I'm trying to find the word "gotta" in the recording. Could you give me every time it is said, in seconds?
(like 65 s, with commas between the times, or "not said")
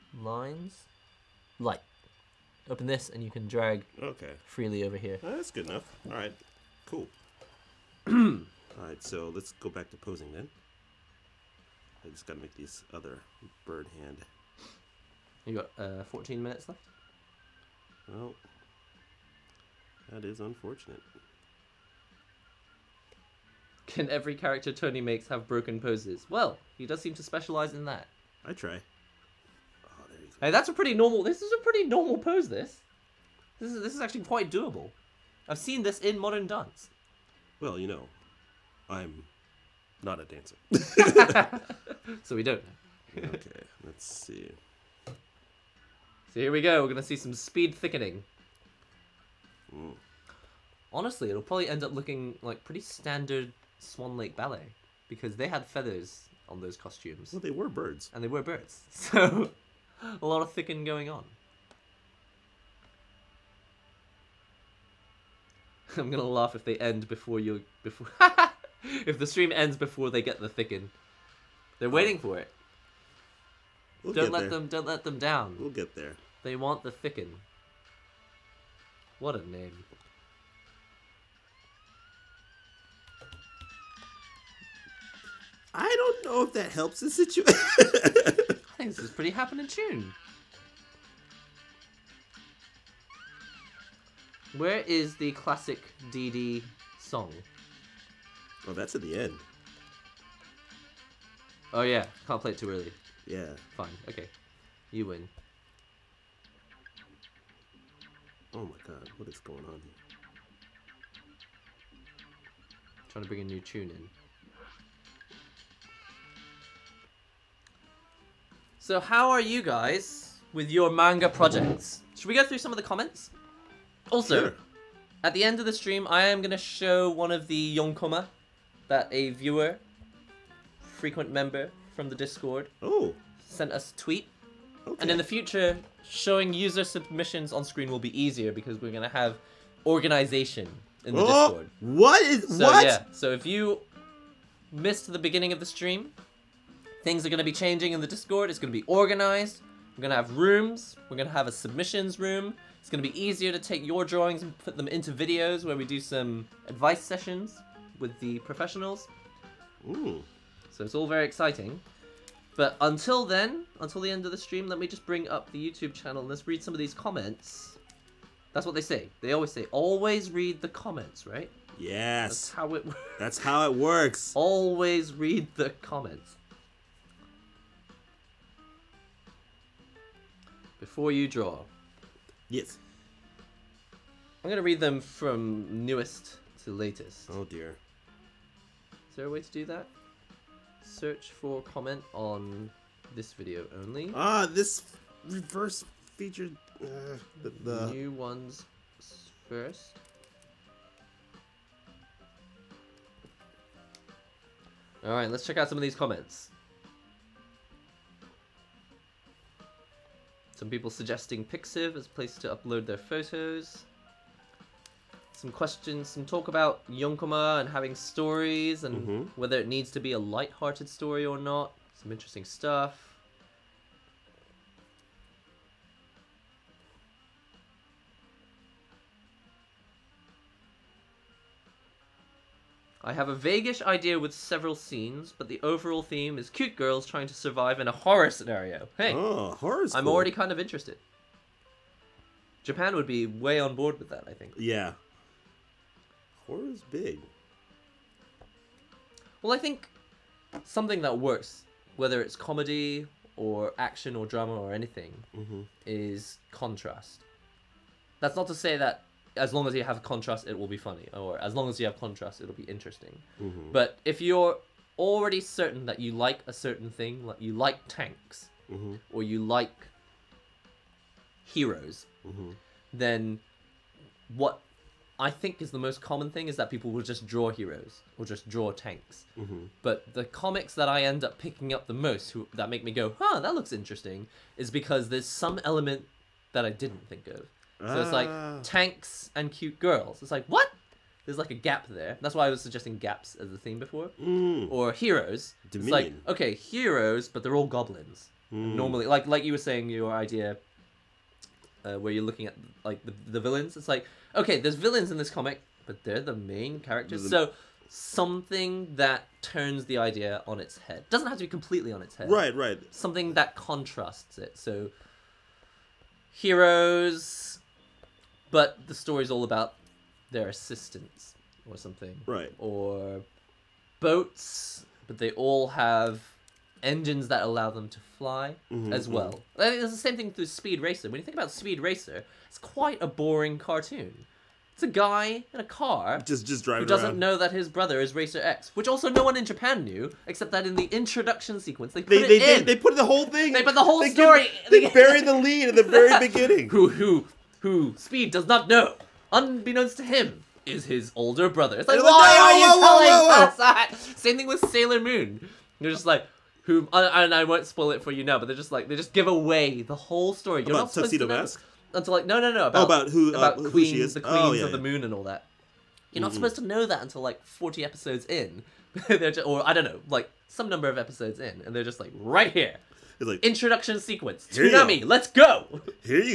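12 s.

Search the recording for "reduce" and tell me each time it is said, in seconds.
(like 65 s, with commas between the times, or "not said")
not said.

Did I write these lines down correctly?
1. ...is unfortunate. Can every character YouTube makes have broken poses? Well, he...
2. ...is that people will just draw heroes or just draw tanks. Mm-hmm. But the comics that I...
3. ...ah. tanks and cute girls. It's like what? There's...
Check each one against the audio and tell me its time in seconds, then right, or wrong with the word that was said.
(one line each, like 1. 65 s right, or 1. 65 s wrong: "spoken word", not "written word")
1. 20 s wrong: "Tony", not "YouTube"
2. 276 s right
3. 288 s right.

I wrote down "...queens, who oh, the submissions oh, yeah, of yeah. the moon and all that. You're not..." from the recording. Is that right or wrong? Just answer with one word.
wrong.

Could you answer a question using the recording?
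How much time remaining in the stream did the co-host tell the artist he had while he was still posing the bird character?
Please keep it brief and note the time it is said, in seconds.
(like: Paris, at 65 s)
14 minutes, at 16 s.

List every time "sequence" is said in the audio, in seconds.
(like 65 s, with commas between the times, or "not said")
341 s, 373 s.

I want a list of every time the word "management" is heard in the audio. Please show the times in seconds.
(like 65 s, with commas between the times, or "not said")
not said.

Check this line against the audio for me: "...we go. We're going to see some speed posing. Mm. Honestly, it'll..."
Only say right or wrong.
wrong.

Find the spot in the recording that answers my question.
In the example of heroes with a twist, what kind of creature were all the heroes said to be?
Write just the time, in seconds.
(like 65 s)
297 s.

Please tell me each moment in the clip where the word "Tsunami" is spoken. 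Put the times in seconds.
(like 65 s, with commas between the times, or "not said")
374 s.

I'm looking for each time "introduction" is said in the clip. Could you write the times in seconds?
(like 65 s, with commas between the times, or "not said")
340 s, 373 s.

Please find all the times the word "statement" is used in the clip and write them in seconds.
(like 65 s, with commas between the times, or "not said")
not said.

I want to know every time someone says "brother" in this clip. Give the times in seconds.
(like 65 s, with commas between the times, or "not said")
337 s, 351 s.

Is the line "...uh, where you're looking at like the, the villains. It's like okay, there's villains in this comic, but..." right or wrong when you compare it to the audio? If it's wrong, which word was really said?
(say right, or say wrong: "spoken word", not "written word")
right.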